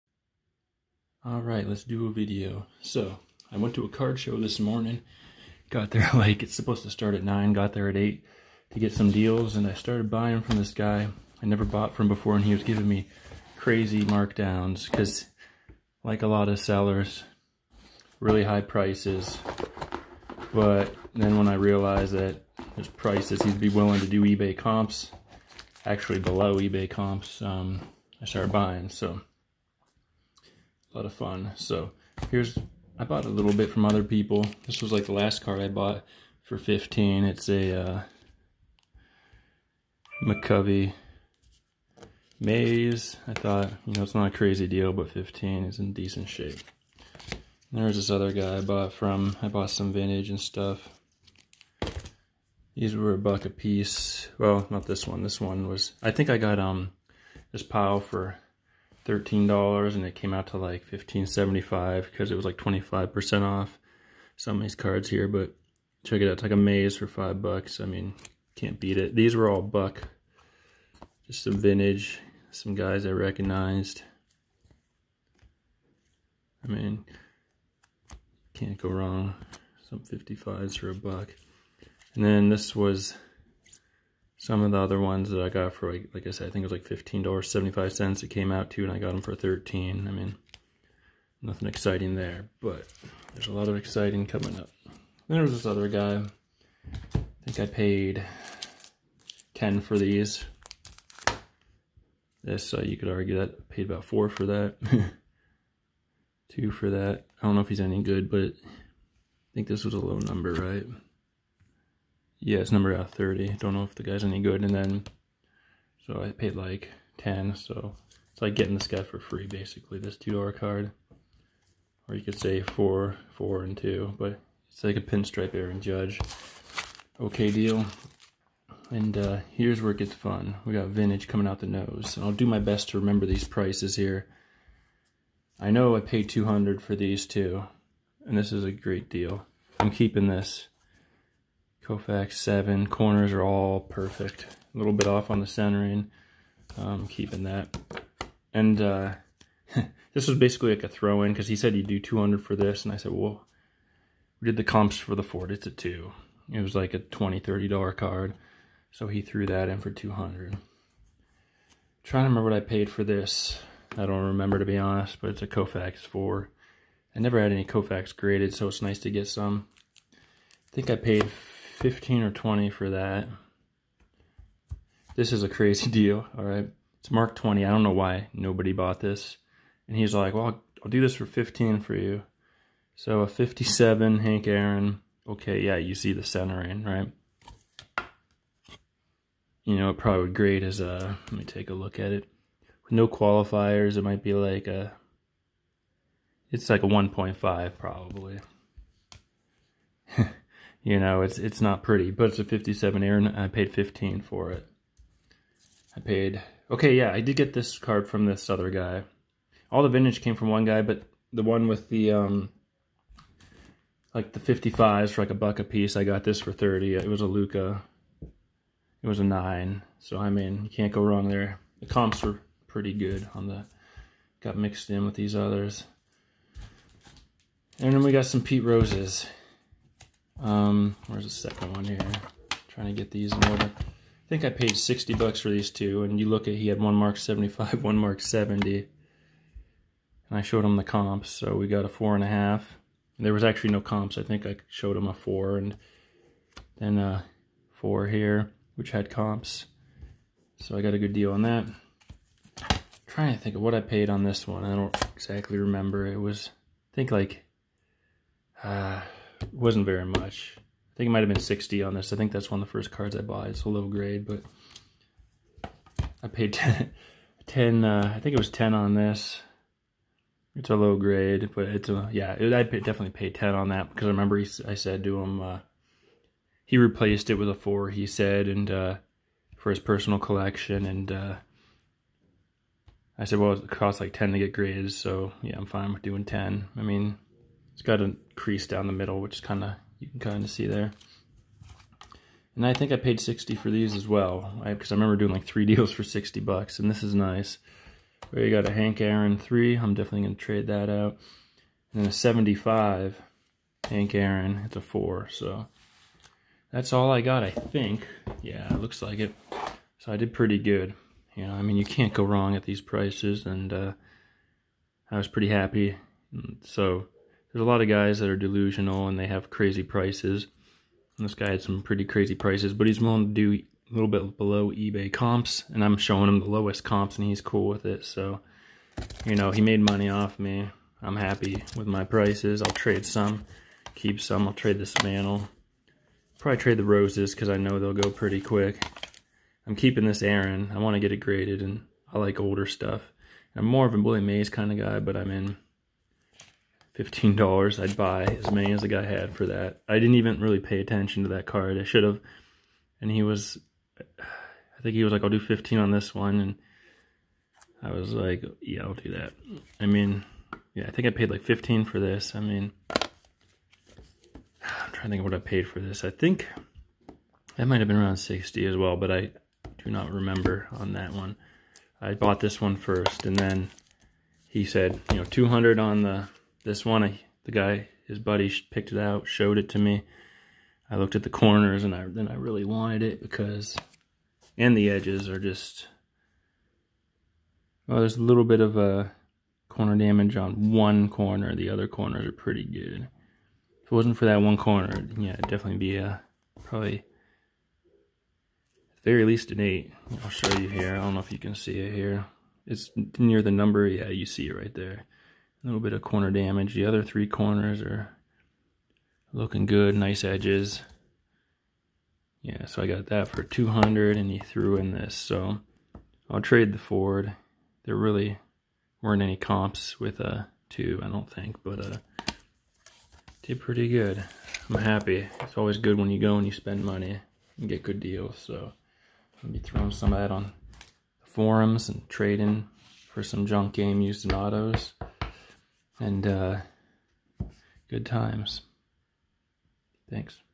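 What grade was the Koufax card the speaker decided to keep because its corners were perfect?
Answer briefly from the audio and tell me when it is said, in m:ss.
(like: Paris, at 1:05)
7, at 2:21.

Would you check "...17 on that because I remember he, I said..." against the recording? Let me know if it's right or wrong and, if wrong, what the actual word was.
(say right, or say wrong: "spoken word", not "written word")
wrong: "10", not "17".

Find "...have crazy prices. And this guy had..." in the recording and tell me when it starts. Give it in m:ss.
5:19.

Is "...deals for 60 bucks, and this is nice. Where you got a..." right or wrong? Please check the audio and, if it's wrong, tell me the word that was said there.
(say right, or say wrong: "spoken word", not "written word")
right.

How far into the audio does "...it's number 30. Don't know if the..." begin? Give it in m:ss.
1:52.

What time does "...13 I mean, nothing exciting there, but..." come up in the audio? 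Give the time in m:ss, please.
1:29.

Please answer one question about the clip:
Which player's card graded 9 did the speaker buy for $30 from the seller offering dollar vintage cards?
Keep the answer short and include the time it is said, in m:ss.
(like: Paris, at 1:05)
Luka, at 3:36.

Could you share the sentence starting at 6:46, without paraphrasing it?
The other three corners are looking good, nice edges.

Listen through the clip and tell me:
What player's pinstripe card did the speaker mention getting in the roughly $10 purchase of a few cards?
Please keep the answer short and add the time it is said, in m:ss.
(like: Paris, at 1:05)
Aaron Judge, at 2:05.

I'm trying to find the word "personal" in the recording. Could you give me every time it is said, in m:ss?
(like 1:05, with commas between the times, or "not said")
4:39.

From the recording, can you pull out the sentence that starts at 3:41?
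The comps were pretty good on the...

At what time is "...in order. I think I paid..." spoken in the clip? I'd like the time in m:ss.
3:53.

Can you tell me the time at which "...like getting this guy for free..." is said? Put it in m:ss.
1:58.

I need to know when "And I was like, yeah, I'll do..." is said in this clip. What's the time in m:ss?
5:56.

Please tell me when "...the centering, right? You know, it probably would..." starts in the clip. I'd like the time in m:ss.
3:06.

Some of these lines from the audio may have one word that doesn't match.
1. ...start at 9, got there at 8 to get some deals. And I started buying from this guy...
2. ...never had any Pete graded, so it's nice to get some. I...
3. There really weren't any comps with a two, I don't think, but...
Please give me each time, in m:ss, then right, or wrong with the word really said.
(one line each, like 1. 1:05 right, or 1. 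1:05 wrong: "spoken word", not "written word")
1. 0:06 right
2. 2:47 wrong: "Koufax", not "Pete"
3. 6:57 right.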